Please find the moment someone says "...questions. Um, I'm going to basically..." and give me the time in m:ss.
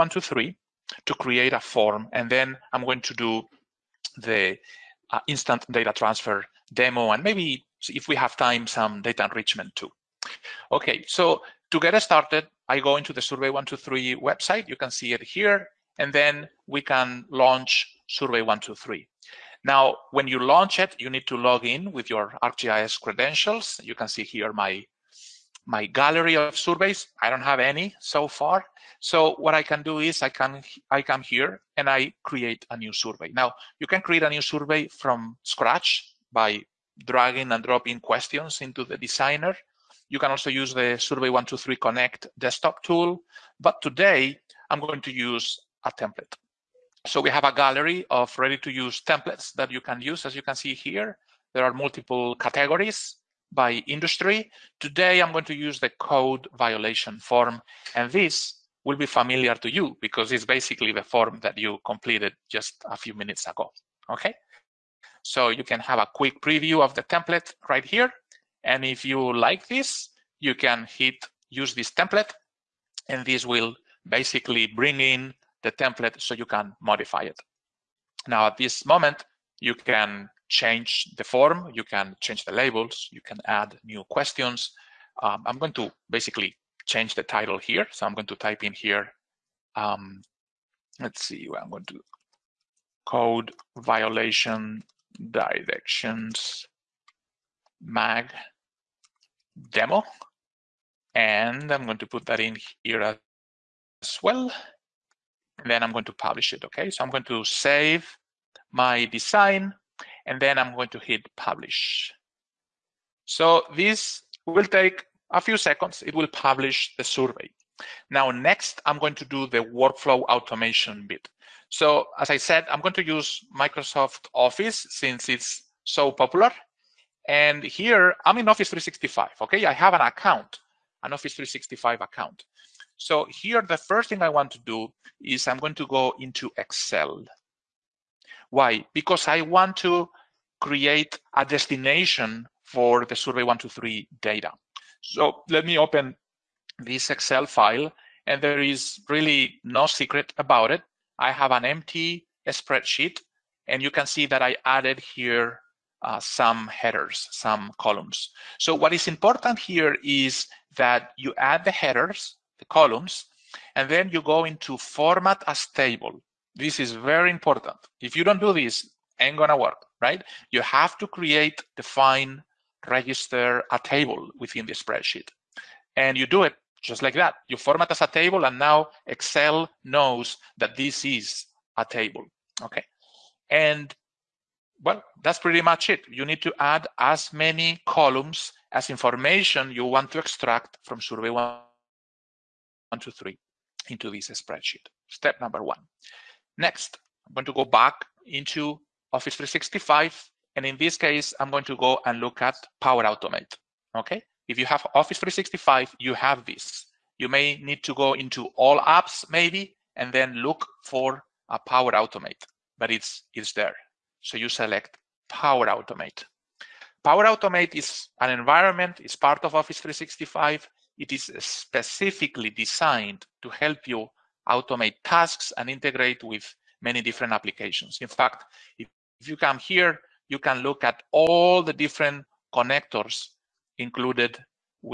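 1:24.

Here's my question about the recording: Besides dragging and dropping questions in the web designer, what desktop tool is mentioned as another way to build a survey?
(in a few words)
Survey123 Connect.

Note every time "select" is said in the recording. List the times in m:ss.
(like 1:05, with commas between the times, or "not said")
3:34.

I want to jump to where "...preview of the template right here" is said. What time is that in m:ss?
1:06.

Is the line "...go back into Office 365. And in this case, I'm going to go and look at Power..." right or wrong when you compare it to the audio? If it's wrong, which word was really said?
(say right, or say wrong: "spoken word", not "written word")
right.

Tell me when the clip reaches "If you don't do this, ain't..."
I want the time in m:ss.
2:48.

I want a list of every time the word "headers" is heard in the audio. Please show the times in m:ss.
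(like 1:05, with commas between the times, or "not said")
2:36, 2:41.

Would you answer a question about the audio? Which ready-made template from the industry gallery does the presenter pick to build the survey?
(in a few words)
Code violation form.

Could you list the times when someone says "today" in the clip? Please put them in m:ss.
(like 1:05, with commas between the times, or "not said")
0:43, 0:54.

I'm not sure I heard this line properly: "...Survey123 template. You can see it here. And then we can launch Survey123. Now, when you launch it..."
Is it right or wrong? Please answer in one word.
wrong.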